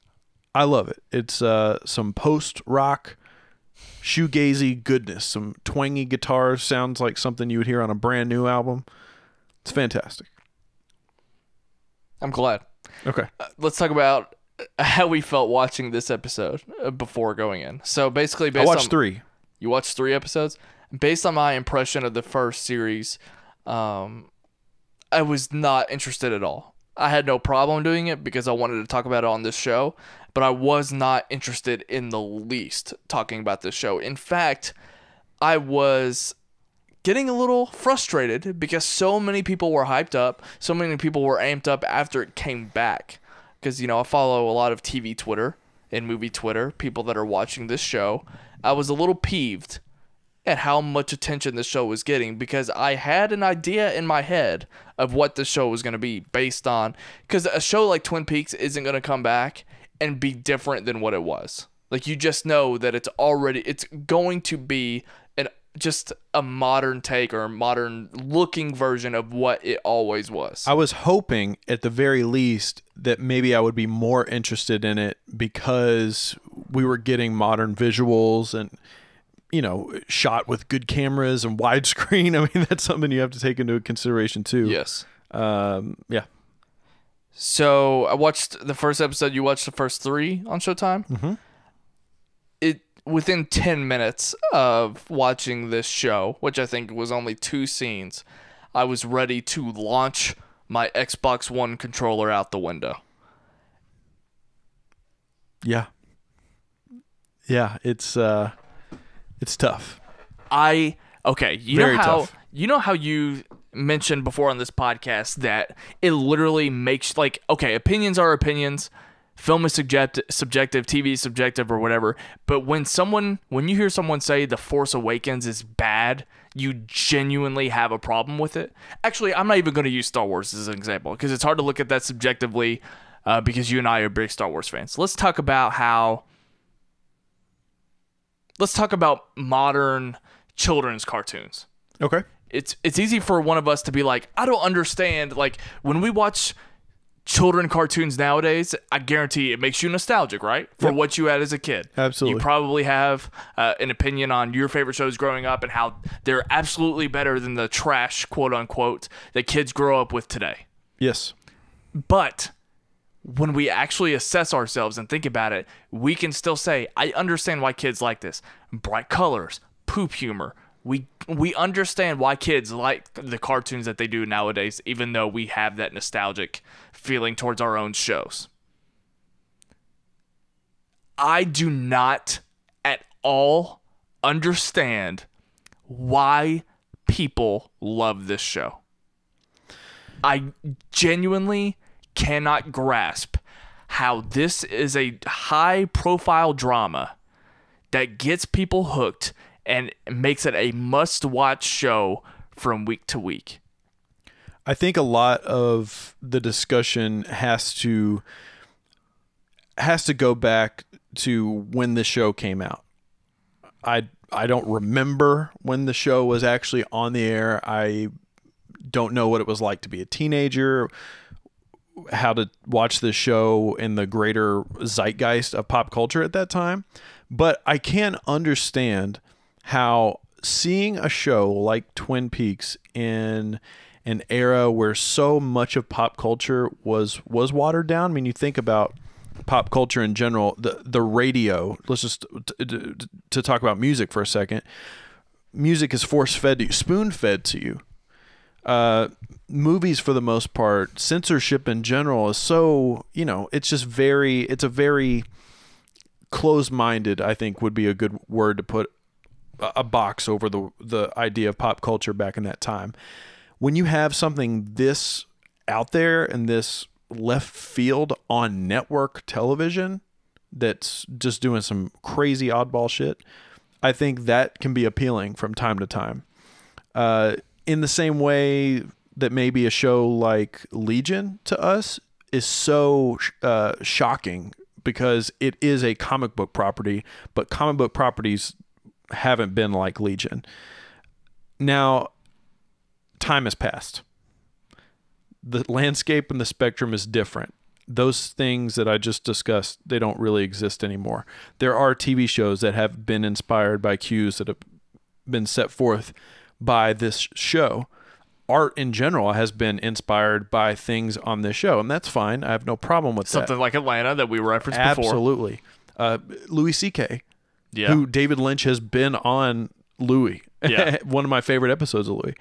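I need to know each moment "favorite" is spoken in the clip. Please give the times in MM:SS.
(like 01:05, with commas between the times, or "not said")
02:34, 05:21.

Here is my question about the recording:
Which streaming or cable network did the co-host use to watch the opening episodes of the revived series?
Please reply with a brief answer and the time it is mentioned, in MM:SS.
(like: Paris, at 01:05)
Showtime, at 01:30.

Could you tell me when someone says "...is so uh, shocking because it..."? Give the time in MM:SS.
04:42.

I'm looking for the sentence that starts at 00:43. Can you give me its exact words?
Because, you know, I follow a lot of TV Twitter and movie Twitter, people that are watching this show.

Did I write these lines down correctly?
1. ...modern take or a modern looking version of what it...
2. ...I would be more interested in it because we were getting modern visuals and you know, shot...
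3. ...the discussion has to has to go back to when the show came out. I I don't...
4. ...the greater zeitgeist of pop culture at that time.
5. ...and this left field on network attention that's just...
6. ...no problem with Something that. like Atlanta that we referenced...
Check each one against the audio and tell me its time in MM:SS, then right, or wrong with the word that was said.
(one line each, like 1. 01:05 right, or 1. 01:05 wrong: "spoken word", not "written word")
1. 01:06 right
2. 01:13 right
3. 03:26 right
4. 03:43 right
5. 04:26 wrong: "television", not "attention"
6. 05:12 right.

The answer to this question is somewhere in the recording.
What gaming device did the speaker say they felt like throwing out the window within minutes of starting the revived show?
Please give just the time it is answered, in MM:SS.
01:40.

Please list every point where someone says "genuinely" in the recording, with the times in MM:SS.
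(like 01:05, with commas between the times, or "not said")
02:06, 03:10.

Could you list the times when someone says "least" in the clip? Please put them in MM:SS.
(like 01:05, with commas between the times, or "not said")
00:32, 01:12.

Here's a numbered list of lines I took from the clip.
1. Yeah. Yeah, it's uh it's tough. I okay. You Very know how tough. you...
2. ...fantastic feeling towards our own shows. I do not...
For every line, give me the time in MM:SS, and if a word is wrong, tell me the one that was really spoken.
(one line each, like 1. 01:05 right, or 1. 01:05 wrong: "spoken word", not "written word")
1. 01:45 right
2. 02:55 wrong: "nostalgic", not "fantastic".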